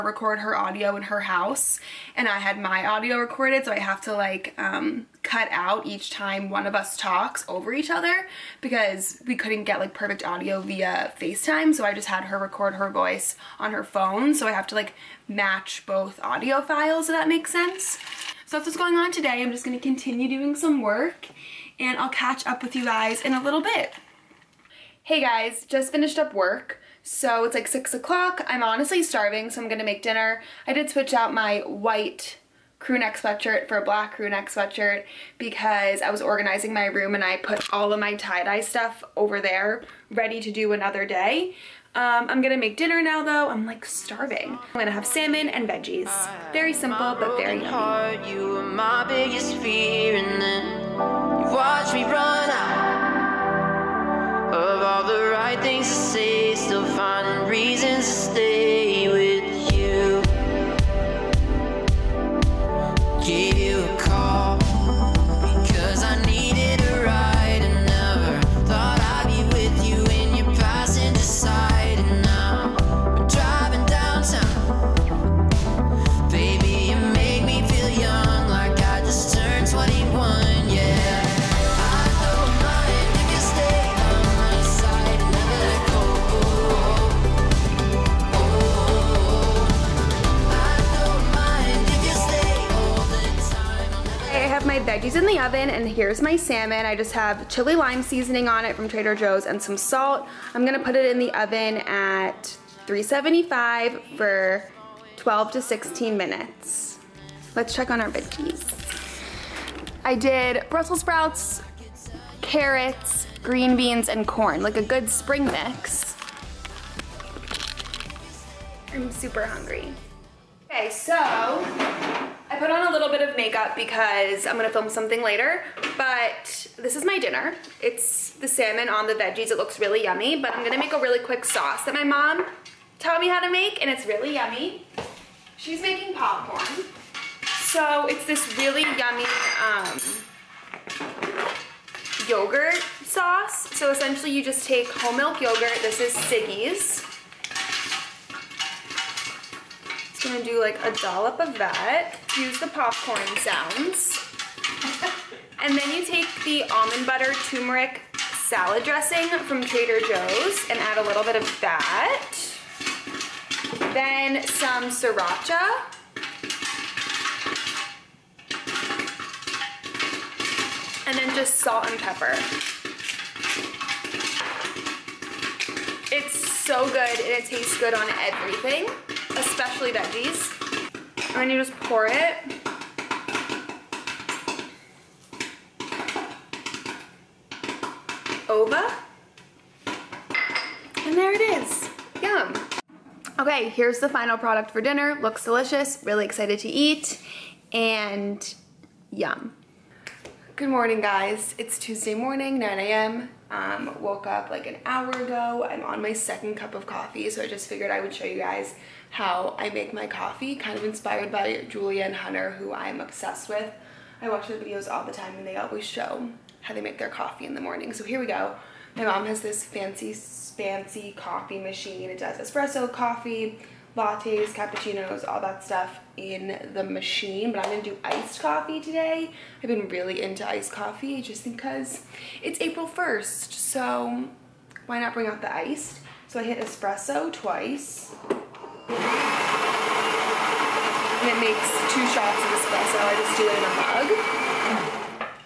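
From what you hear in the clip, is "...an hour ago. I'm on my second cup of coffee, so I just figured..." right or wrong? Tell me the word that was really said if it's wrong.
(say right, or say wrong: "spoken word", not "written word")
right.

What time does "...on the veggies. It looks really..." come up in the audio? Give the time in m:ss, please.
2:08.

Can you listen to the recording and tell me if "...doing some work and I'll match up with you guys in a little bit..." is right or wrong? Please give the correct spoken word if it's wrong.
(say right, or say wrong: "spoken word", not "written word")
wrong: "catch", not "match".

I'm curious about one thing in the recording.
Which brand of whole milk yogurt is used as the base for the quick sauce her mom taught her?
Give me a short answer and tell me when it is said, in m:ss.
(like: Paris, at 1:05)
Siggi's, at 2:26.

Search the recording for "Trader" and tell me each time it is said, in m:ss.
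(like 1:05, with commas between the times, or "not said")
1:38, 2:39.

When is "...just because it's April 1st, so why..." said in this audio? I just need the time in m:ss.
3:51.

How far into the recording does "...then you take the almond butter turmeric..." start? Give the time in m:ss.
2:35.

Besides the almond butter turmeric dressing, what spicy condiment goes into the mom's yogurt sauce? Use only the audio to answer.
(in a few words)
sriracha.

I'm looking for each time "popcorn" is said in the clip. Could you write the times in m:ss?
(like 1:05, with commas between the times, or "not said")
2:16, 2:32.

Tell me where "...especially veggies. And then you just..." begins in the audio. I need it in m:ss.
2:59.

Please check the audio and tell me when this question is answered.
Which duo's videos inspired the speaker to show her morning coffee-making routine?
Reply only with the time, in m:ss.
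3:31.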